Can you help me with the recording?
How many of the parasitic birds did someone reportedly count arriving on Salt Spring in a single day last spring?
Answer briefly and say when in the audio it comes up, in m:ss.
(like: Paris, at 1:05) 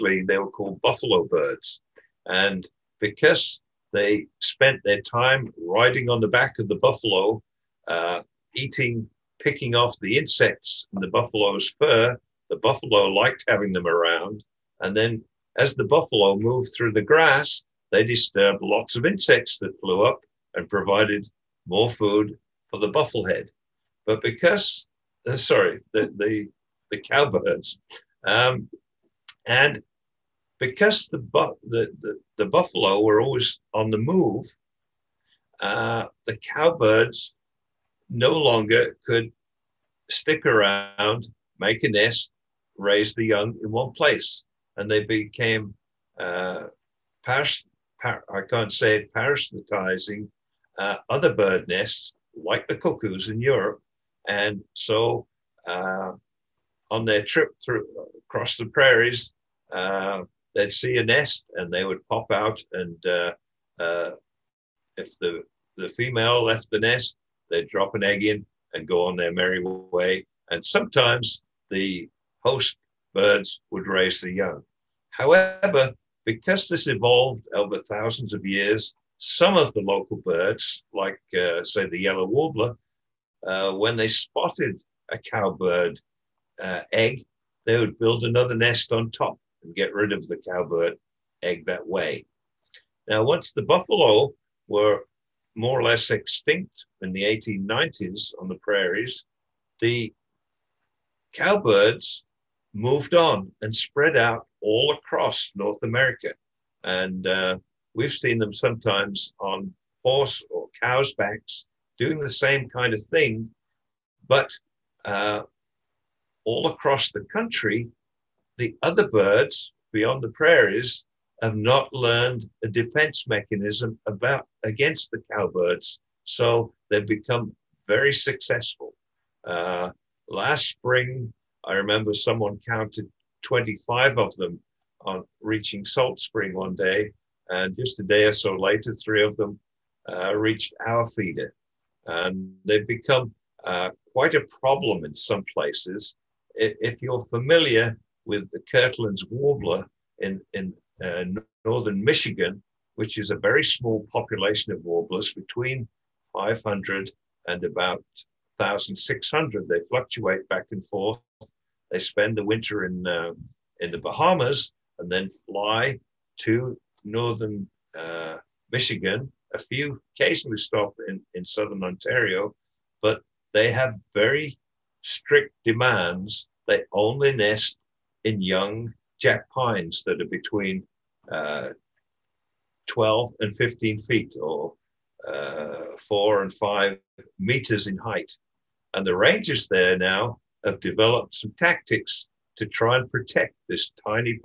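25, at 2:13.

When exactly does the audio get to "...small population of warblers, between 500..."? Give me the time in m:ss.
2:33.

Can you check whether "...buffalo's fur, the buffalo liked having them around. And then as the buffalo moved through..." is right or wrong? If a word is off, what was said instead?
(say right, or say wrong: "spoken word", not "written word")
right.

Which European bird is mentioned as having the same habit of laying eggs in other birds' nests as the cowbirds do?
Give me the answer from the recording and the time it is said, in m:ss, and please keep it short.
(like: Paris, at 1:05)
cuckoos, at 0:52.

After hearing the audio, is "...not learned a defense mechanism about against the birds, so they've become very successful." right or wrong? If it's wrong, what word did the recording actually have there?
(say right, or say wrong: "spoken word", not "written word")
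wrong: "cowbirds", not "birds".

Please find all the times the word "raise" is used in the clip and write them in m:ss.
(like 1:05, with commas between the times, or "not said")
0:42, 1:13.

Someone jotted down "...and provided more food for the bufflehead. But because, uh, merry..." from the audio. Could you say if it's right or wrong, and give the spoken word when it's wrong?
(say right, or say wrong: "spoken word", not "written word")
wrong: "sorry", not "merry".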